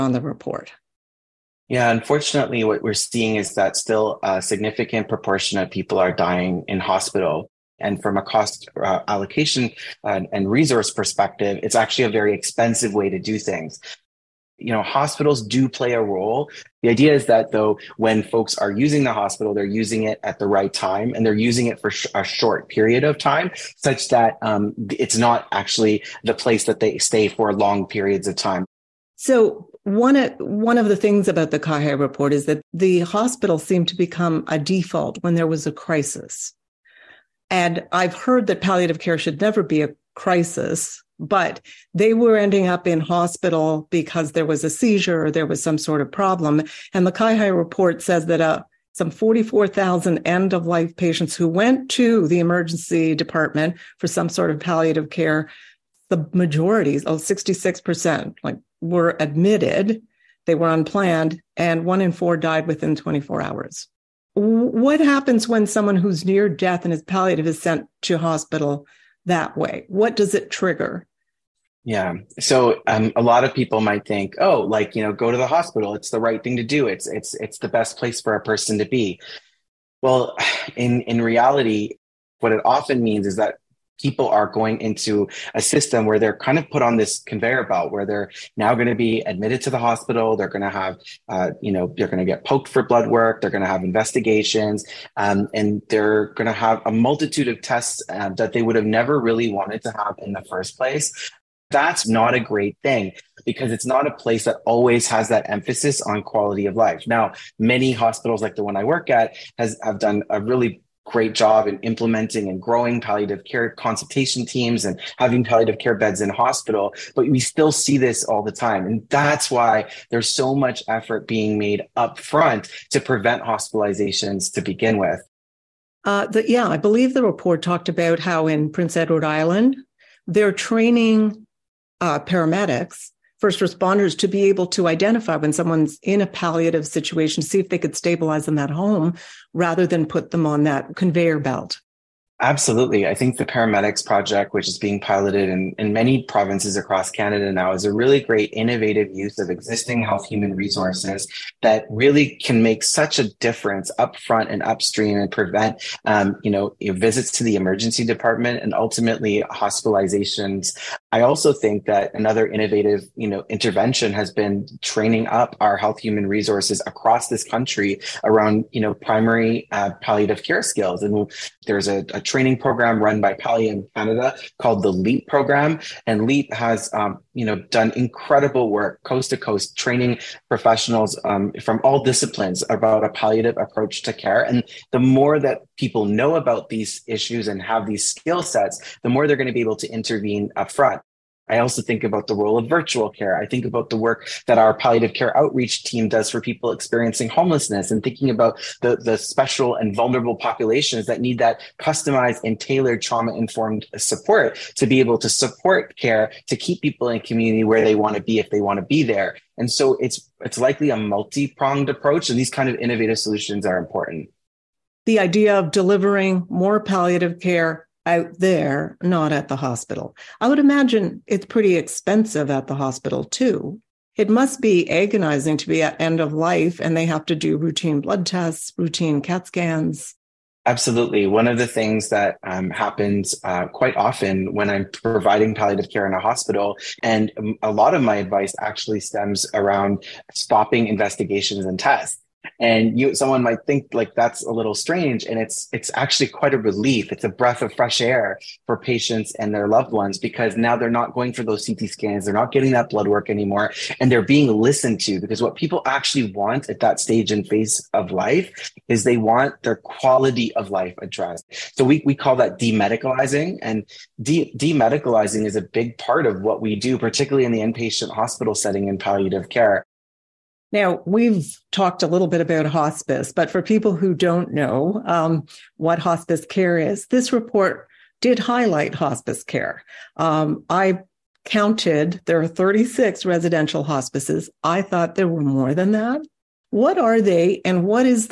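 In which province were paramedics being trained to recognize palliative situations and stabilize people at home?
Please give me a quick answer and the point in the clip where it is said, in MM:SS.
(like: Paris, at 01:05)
Prince Edward Island, at 02:08.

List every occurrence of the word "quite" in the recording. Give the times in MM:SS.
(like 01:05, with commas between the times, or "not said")
03:53, 04:06.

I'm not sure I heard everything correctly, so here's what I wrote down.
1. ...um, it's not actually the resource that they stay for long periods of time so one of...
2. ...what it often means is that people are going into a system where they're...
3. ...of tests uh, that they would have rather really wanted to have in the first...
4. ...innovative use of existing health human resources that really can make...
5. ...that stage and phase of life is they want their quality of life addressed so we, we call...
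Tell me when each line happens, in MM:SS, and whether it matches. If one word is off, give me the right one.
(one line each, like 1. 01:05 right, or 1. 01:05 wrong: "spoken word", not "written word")
1. 00:24 wrong: "place", not "resource"
2. 01:22 right
3. 01:37 wrong: "never", not "rather"
4. 02:28 right
5. 04:16 right.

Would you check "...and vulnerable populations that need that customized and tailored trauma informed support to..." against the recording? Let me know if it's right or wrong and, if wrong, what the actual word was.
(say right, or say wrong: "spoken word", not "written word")
right.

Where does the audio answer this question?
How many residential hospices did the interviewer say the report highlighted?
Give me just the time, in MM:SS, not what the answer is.
04:42.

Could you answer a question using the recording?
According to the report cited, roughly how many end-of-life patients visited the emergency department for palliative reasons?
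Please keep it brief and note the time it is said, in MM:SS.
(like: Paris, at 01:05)
44,000, at 00:49.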